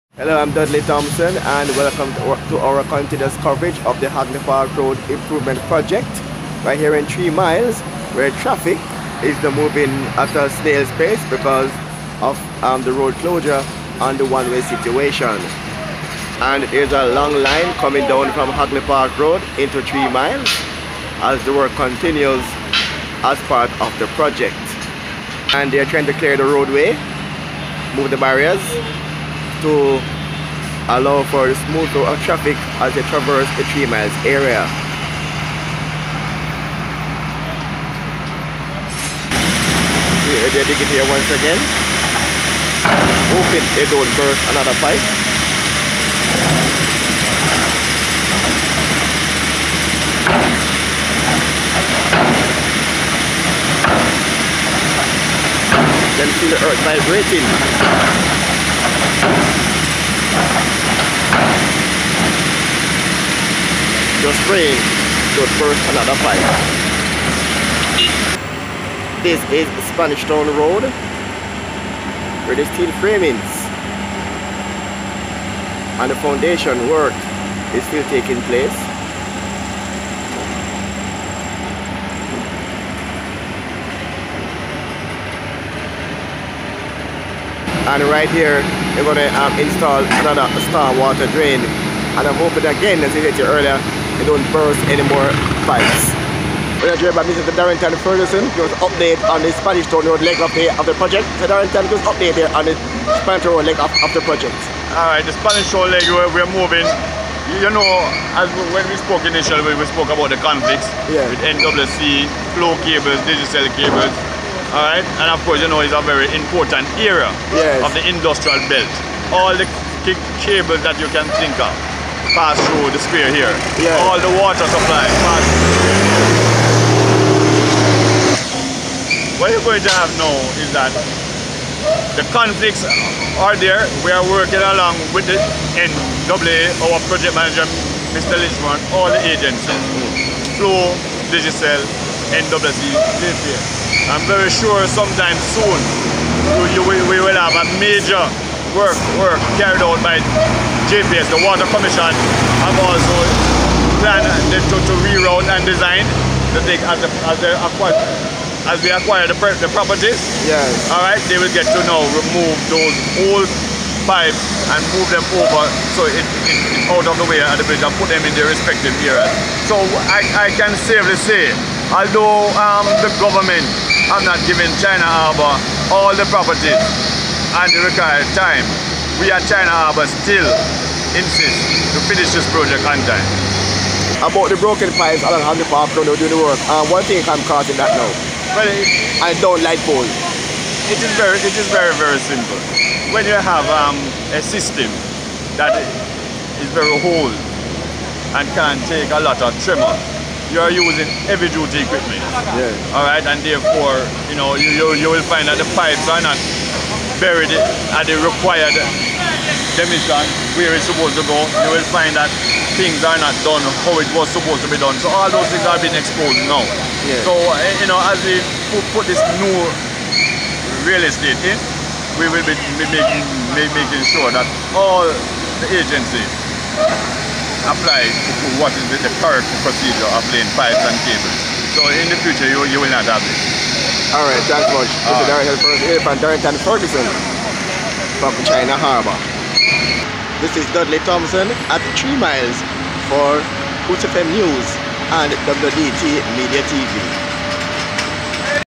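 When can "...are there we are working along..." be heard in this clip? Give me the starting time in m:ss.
2:13.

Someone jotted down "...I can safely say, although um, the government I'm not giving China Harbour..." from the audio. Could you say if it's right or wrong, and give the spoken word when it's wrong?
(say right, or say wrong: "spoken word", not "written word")
right.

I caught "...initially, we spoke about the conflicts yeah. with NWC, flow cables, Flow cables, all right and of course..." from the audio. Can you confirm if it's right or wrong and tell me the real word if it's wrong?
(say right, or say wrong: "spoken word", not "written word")
wrong: "Digicel", not "Flow".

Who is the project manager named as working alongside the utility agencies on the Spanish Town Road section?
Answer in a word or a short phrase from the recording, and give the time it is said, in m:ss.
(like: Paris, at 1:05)
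Mr. Lichman, at 2:18.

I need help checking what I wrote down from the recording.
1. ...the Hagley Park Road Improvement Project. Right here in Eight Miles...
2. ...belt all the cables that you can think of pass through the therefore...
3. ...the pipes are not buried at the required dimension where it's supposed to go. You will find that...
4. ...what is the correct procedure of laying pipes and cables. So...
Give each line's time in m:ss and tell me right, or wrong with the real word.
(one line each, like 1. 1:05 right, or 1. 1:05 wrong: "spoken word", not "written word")
1. 0:04 wrong: "Three", not "Eight"
2. 1:58 wrong: "sphere", not "therefore"
3. 3:25 right
4. 3:48 right.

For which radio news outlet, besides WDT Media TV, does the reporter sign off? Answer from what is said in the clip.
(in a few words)
Hoots FM News.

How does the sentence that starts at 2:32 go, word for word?
I'm also planned to, to reroute and design the thing as the, as the as we acquire the, the properties.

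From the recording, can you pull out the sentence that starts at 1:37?
Darrington Ferguson give us update on the Spanish Town Road leg of the, of the project.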